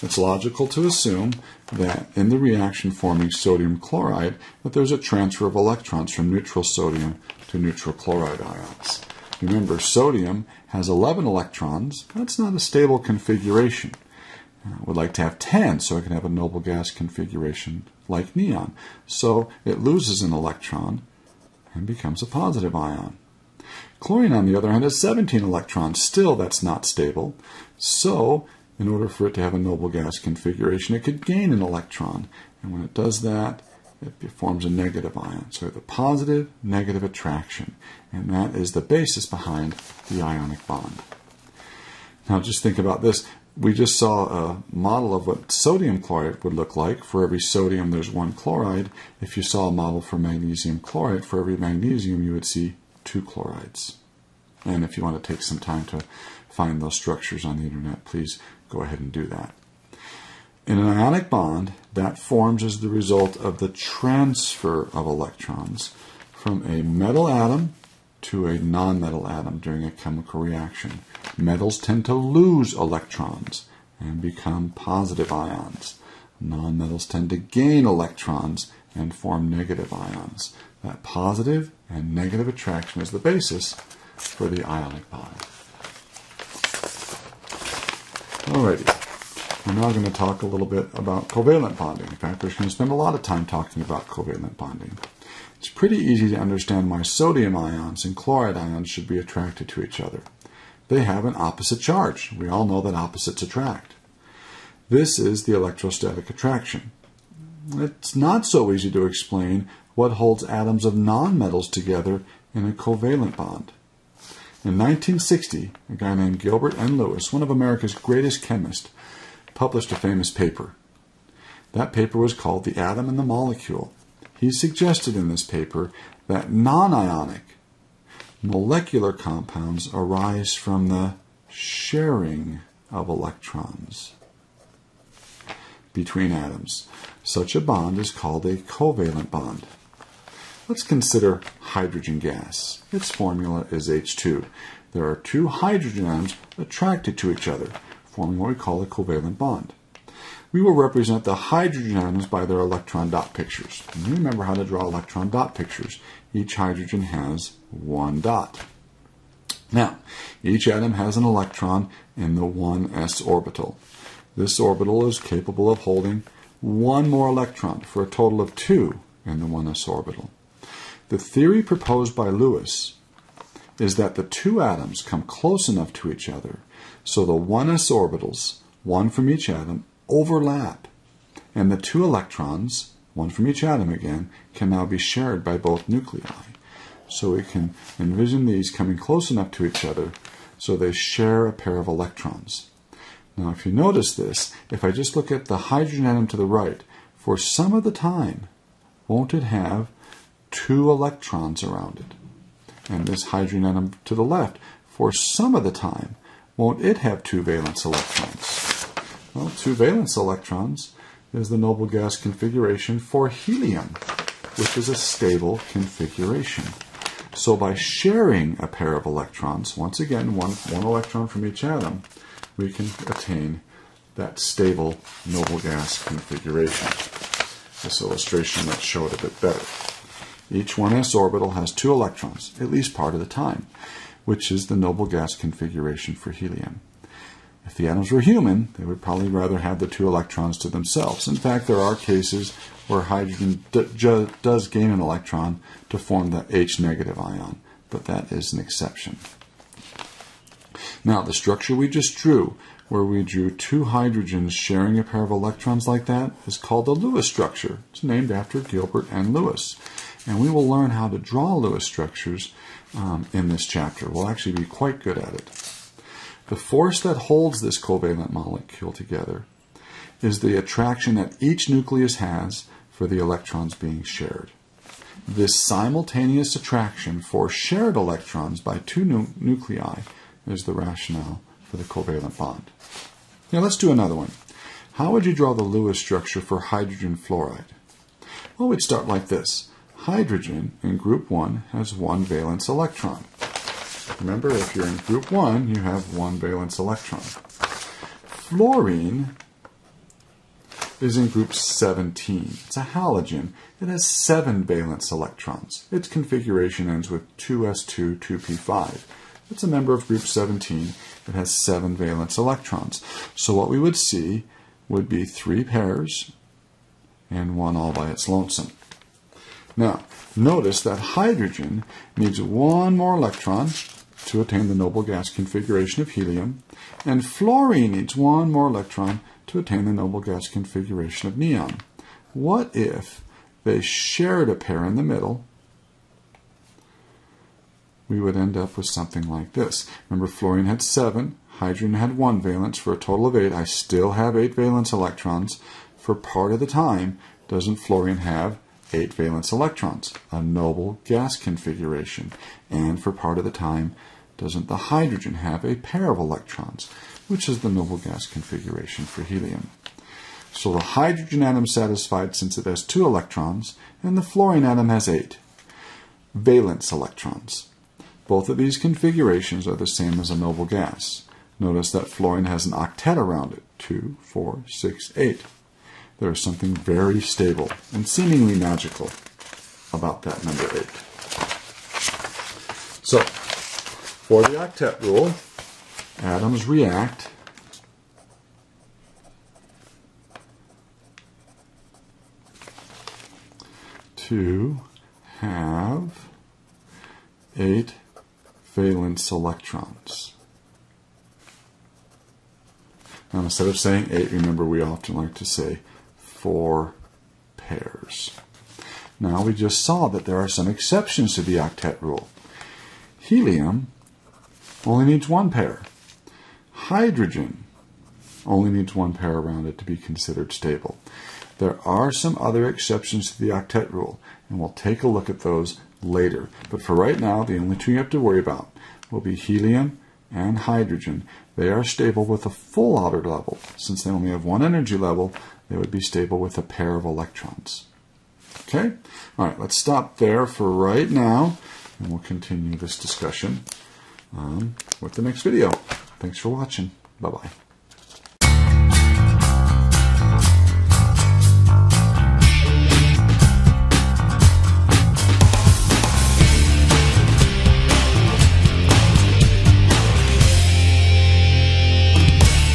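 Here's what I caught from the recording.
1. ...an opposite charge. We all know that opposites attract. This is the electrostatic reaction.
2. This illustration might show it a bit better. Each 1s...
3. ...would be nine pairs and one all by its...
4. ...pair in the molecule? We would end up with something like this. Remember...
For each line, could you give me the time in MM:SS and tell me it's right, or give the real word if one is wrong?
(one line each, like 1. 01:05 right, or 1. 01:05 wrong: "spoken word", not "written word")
1. 01:41 wrong: "attraction", not "reaction"
2. 03:47 right
3. 05:14 wrong: "three", not "nine"
4. 05:34 wrong: "middle", not "molecule".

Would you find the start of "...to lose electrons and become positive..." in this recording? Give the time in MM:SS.
01:12.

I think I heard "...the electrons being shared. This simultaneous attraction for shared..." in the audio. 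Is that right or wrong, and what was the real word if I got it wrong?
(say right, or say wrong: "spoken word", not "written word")
right.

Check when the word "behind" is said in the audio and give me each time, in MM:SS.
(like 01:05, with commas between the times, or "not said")
00:39.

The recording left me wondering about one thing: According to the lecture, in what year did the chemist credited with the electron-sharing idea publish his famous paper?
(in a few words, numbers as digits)
1960.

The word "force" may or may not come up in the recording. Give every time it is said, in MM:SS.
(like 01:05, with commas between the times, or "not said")
04:26.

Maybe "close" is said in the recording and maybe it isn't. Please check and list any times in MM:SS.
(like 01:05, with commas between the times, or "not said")
02:55, 03:08.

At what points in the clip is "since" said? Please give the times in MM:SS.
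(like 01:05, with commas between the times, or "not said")
06:02, 07:13.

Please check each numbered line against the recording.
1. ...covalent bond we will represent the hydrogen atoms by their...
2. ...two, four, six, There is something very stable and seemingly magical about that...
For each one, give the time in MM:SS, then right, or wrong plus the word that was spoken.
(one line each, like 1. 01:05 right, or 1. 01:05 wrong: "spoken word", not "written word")
1. 02:28 right
2. 06:13 right.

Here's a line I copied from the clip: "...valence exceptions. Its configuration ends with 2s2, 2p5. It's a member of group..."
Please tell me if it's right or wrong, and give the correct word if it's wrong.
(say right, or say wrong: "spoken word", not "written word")
wrong: "electrons", not "exceptions".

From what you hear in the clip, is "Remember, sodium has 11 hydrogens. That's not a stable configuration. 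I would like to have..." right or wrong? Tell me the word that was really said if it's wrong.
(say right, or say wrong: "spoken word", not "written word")
wrong: "electrons", not "hydrogens".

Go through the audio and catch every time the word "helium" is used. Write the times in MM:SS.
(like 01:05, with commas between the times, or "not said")
03:33, 03:56, 05:26, 05:59, 06:53, 07:09.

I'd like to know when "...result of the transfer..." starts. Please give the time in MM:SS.
01:02.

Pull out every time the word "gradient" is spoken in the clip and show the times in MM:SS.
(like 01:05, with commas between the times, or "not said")
not said.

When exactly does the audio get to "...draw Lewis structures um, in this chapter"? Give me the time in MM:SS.
04:21.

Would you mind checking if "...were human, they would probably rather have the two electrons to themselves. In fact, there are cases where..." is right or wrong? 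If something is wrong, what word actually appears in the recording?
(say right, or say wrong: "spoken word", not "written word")
right.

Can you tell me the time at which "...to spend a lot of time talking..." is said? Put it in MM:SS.
01:32.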